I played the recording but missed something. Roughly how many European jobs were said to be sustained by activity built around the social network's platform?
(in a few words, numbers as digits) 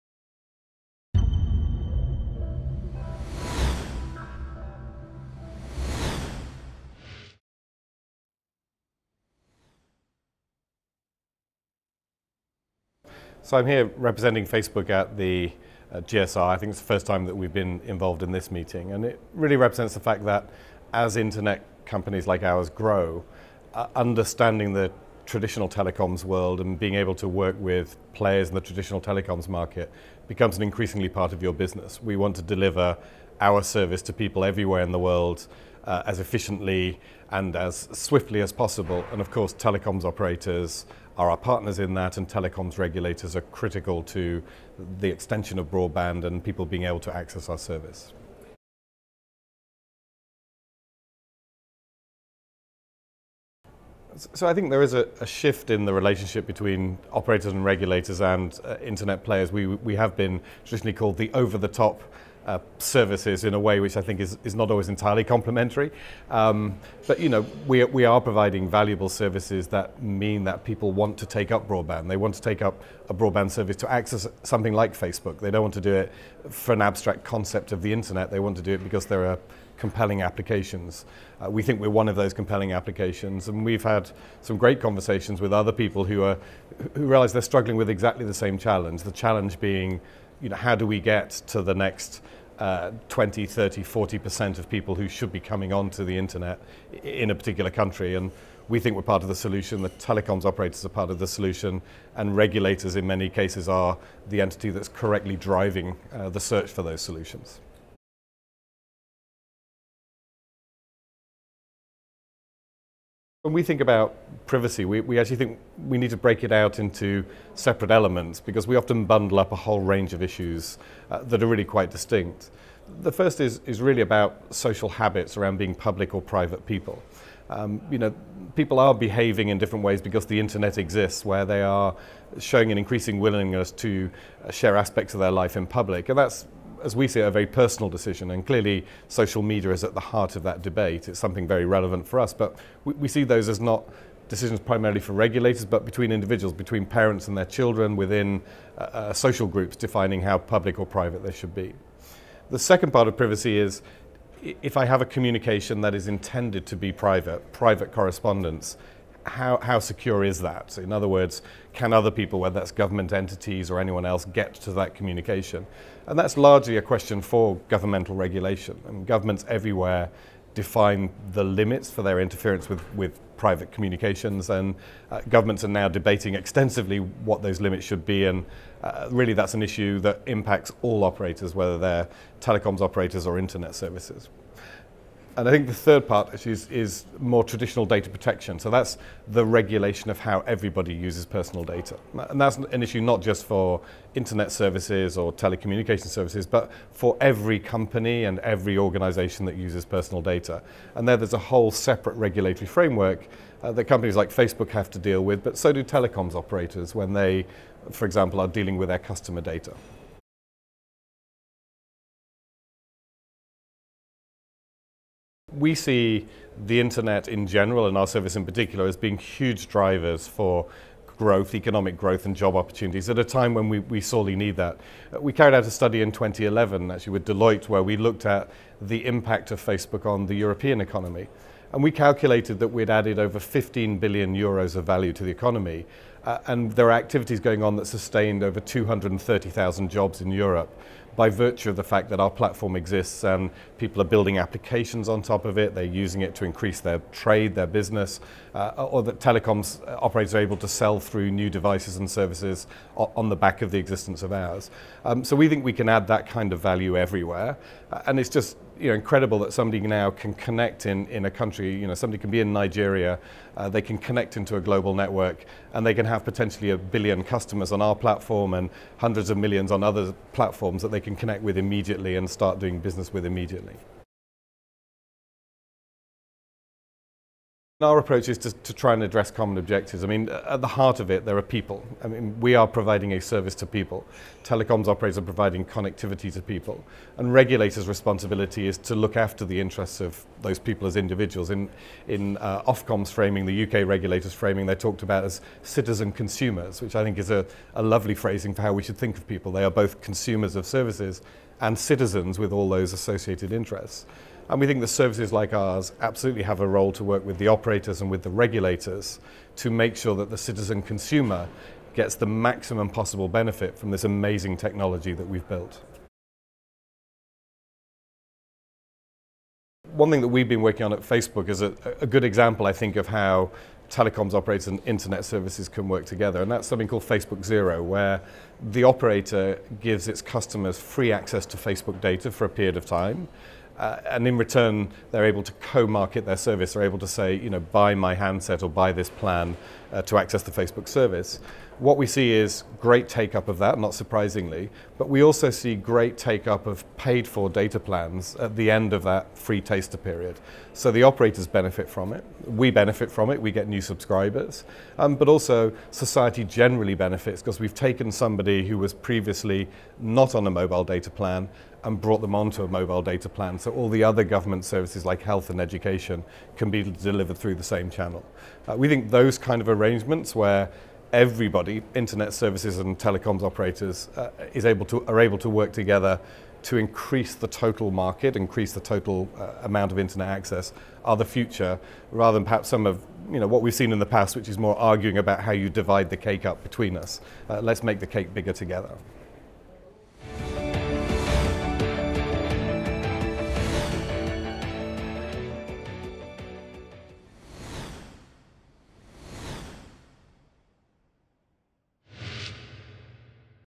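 230,000.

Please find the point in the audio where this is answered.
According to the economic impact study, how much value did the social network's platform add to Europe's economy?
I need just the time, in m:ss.
3:53.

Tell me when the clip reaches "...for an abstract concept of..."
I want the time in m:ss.
1:16.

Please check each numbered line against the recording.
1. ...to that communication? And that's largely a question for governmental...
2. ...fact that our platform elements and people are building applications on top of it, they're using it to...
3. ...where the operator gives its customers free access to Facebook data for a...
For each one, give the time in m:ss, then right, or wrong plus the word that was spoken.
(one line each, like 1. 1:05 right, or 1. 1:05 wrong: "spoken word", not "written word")
1. 2:44 right
2. 4:01 wrong: "exists", not "elements"
3. 5:27 right.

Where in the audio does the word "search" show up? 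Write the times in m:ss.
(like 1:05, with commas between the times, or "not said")
1:46.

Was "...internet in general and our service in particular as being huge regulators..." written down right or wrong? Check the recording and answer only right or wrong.
wrong.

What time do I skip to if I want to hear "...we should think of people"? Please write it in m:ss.
4:58.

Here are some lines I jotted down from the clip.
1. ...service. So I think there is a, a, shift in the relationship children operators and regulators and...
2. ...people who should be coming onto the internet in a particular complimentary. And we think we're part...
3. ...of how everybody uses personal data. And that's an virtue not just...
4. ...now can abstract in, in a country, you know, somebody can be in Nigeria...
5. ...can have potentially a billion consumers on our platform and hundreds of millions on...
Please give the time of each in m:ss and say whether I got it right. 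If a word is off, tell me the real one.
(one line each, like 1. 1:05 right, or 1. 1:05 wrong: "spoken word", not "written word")
1. 0:47 wrong: "between", not "children"
2. 1:34 wrong: "country", not "complimentary"
3. 3:10 wrong: "issue", not "virtue"
4. 4:19 wrong: "connect", not "abstract"
5. 4:25 wrong: "customers", not "consumers".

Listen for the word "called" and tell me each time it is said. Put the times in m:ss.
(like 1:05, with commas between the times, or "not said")
1:00, 5:26.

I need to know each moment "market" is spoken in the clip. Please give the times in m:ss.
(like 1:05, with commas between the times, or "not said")
0:29, 5:35, 6:17.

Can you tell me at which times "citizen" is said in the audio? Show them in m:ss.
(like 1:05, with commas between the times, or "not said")
4:55, 5:01, 5:10.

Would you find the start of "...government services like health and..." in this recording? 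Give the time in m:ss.
6:04.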